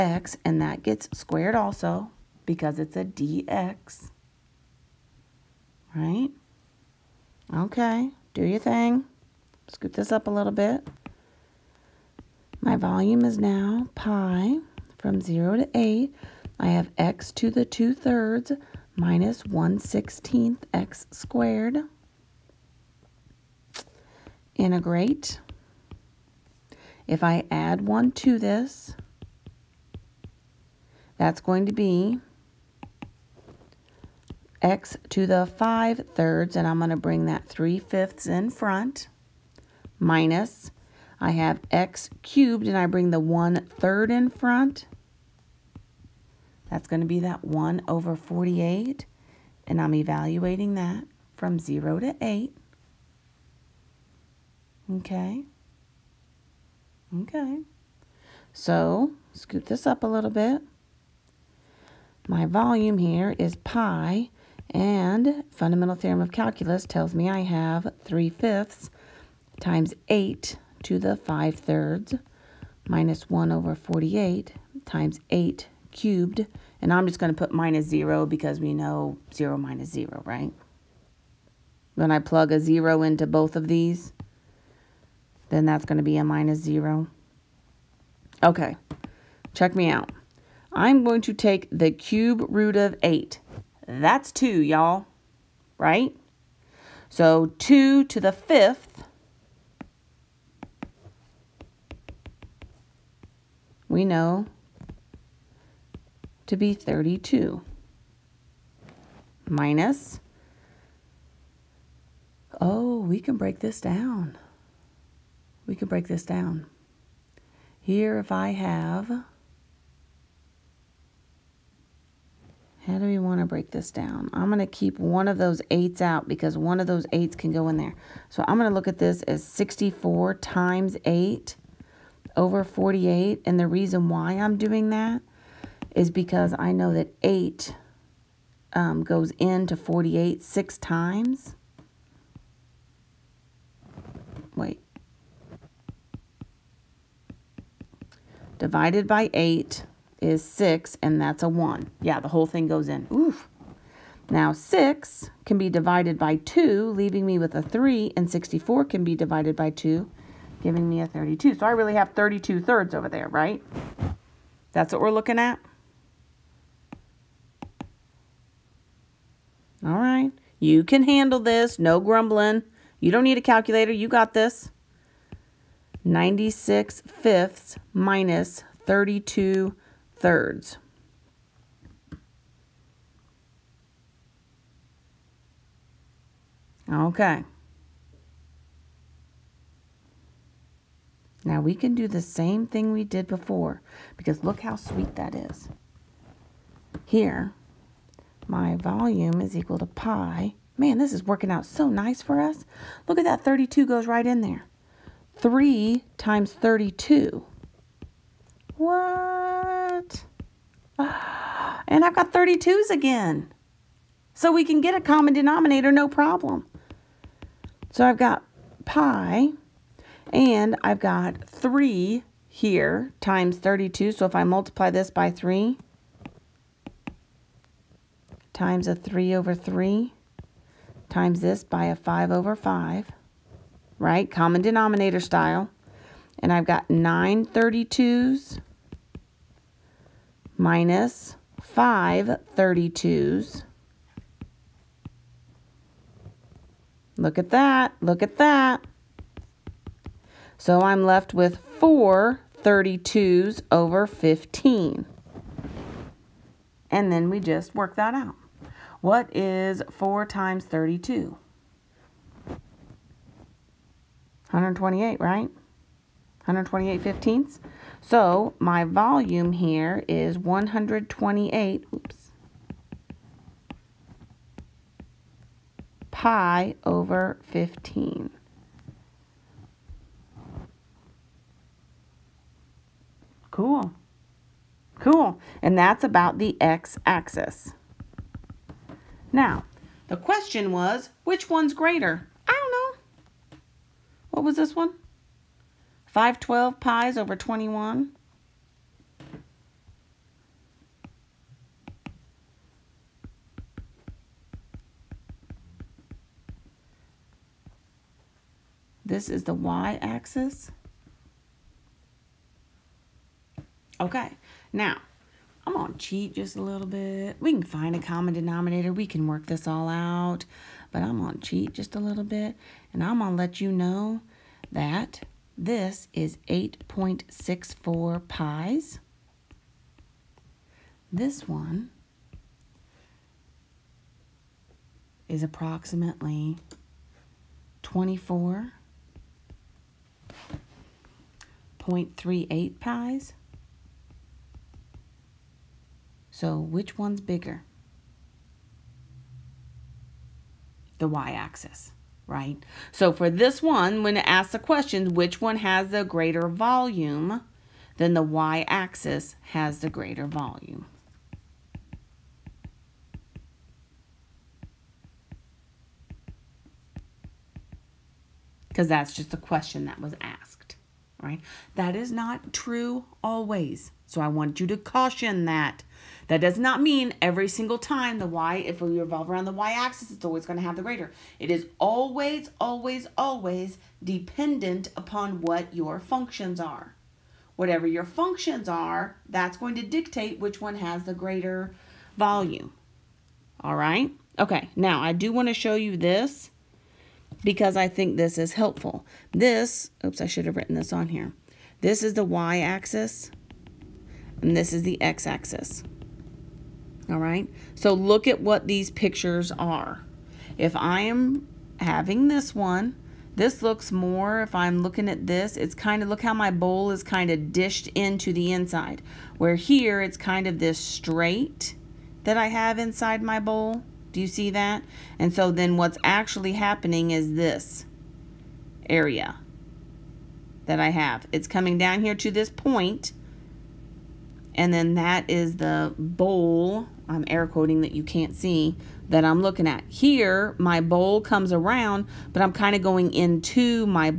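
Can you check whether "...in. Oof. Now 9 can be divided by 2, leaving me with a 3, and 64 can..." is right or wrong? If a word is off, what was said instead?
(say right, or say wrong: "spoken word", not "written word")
wrong: "6", not "9".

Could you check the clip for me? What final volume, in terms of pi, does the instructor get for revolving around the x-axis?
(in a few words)
128 pi/15.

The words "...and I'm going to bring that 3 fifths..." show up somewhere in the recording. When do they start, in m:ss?
0:36.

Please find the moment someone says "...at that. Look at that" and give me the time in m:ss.
4:07.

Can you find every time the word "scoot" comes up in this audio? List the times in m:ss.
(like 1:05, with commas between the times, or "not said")
0:09, 0:59.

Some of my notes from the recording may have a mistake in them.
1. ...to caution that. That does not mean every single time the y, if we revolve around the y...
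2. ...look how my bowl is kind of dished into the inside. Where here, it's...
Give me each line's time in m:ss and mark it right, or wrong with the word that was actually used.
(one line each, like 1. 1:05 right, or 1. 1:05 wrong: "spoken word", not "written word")
1. 6:14 right
2. 6:56 right.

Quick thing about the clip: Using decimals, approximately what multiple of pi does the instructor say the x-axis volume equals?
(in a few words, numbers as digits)
8.64.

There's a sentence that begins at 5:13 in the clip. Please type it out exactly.
Okay, now I'm gonna cheat just a little bit.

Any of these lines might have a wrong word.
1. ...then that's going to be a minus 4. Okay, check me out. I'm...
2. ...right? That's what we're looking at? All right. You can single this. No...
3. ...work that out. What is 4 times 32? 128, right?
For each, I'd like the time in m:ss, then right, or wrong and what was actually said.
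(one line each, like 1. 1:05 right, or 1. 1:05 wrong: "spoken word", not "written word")
1. 1:25 wrong: "0", not "4"
2. 2:43 wrong: "handle", not "single"
3. 4:17 right.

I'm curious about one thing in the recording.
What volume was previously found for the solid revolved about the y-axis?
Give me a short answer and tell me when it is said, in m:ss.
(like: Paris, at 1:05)
512 pi/21, at 4:56.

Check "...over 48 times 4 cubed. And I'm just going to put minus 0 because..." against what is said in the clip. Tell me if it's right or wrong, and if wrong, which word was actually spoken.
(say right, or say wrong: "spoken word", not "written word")
wrong: "8", not "4".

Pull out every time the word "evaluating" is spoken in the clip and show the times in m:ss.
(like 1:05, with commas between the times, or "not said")
0:49.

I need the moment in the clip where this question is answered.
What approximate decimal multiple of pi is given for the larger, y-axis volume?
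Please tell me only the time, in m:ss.
5:37.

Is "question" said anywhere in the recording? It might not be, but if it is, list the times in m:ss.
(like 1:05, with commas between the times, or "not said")
4:50, 5:54, 6:09.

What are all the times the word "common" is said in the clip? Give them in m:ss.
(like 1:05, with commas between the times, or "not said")
3:34, 3:54, 5:17.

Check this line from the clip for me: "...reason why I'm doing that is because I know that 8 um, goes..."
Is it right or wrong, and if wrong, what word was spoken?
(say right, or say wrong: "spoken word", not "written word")
right.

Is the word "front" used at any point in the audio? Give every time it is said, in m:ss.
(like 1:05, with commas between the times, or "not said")
0:38, 0:44.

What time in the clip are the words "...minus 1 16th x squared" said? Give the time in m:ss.
0:18.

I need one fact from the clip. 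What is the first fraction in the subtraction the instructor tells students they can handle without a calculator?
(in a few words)
96/5.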